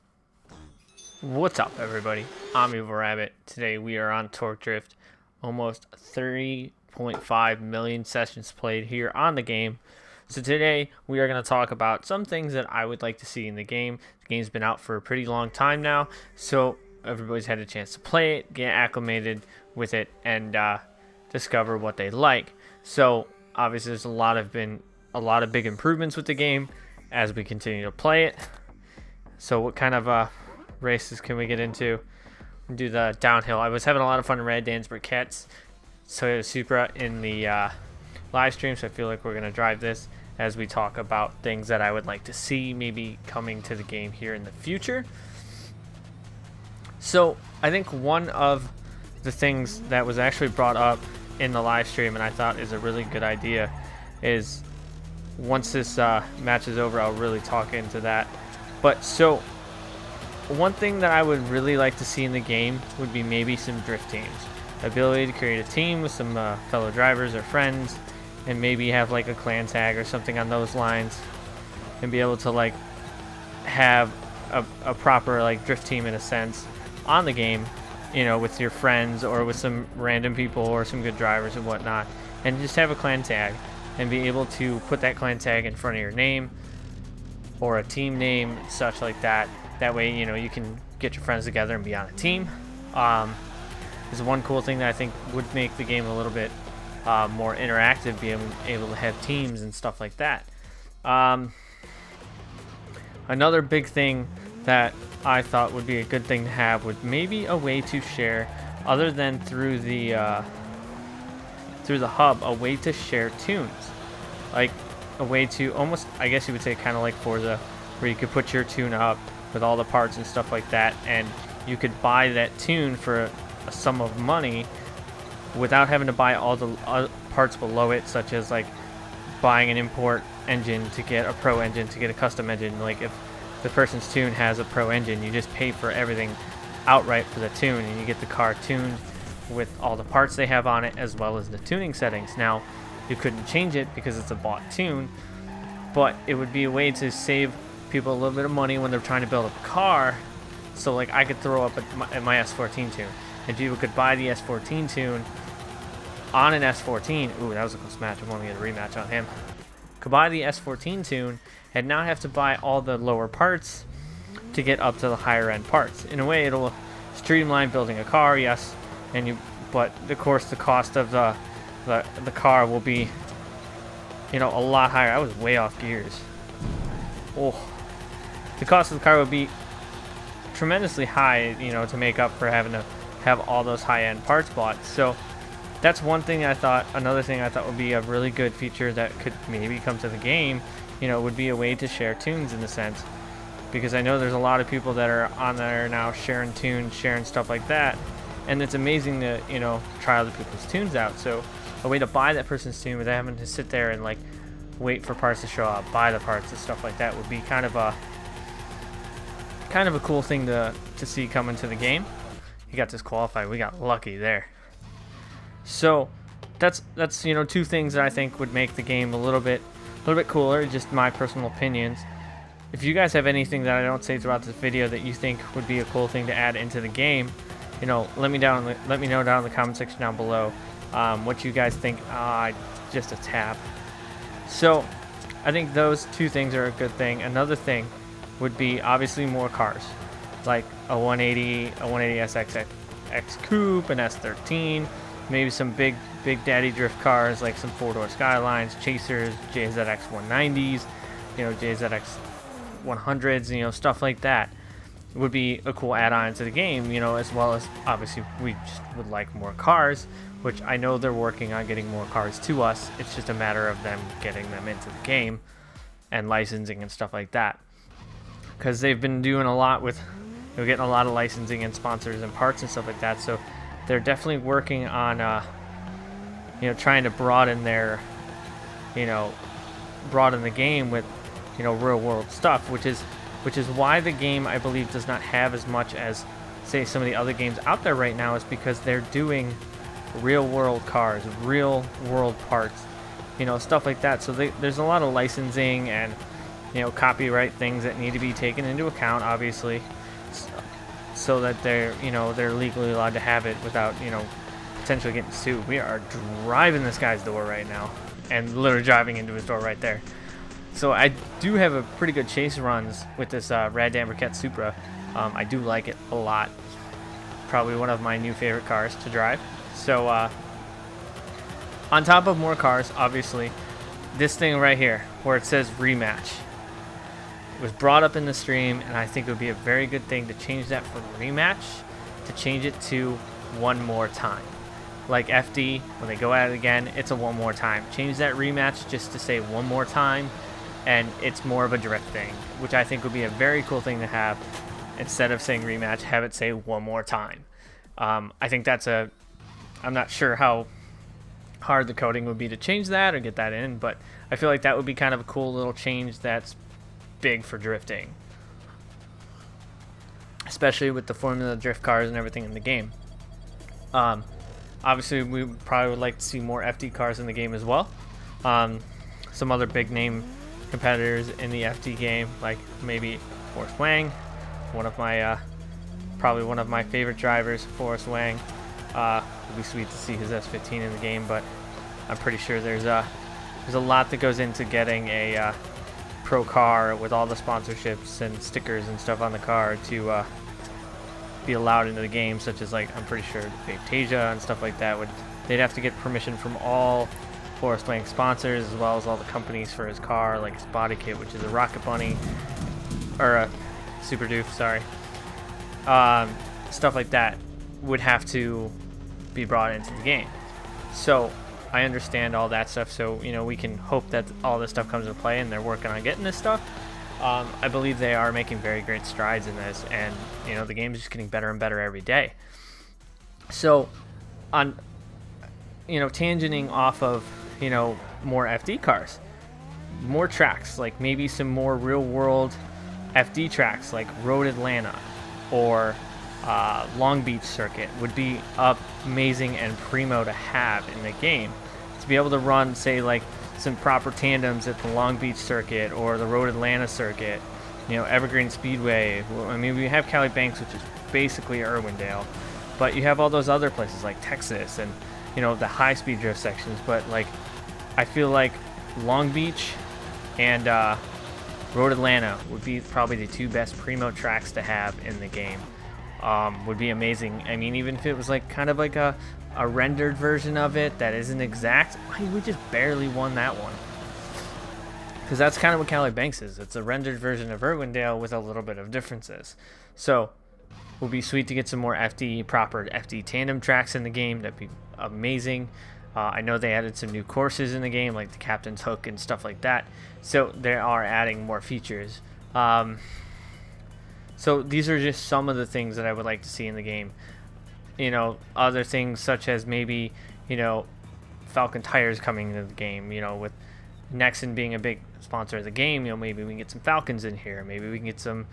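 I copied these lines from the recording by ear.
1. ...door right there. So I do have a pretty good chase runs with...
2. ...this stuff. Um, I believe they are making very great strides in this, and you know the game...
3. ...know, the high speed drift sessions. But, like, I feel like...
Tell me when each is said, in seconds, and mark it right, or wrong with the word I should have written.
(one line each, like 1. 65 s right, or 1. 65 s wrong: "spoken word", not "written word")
1. 309 s right
2. 416 s right
3. 455 s wrong: "sections", not "sessions".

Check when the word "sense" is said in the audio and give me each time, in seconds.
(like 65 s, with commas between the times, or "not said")
76 s, 192 s.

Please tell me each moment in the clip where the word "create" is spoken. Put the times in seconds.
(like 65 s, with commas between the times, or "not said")
65 s.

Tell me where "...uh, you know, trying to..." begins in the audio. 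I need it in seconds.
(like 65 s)
275 s.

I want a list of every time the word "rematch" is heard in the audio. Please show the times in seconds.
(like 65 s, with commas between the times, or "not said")
158 s, 325 s, 331 s, 338 s, 345 s.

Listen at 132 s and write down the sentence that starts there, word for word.
Like if the person's tune has a pro engine.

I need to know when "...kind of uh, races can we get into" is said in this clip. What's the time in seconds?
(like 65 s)
29 s.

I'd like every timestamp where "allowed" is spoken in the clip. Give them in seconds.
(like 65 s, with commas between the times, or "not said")
302 s, 391 s.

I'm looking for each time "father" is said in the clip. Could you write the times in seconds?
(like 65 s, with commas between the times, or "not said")
not said.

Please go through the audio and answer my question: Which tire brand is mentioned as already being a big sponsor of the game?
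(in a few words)
Nexen.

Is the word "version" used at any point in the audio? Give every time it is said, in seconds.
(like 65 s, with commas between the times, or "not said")
470 s, 477 s.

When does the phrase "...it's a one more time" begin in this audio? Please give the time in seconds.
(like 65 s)
336 s.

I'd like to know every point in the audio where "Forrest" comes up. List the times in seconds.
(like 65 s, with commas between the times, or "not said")
373 s, 377 s, 397 s.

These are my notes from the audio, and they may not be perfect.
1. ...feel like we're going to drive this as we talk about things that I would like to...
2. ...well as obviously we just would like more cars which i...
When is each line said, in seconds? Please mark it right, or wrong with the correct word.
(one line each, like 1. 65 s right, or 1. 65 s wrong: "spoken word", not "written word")
1. 38 s right
2. 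257 s right.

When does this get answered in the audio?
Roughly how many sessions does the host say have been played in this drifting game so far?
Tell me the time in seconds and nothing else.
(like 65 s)
5 s.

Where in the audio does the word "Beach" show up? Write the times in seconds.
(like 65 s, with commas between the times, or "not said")
437 s, 445 s, 459 s.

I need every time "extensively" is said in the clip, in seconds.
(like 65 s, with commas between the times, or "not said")
not said.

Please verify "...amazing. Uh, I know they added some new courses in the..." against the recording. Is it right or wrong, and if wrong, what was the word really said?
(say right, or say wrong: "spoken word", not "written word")
right.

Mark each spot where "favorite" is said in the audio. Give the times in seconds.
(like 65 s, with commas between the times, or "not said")
318 s, 376 s.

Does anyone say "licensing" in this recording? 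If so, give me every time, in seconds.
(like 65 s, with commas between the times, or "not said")
266 s, 271 s, 295 s.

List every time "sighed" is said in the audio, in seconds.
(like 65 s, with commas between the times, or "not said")
not said.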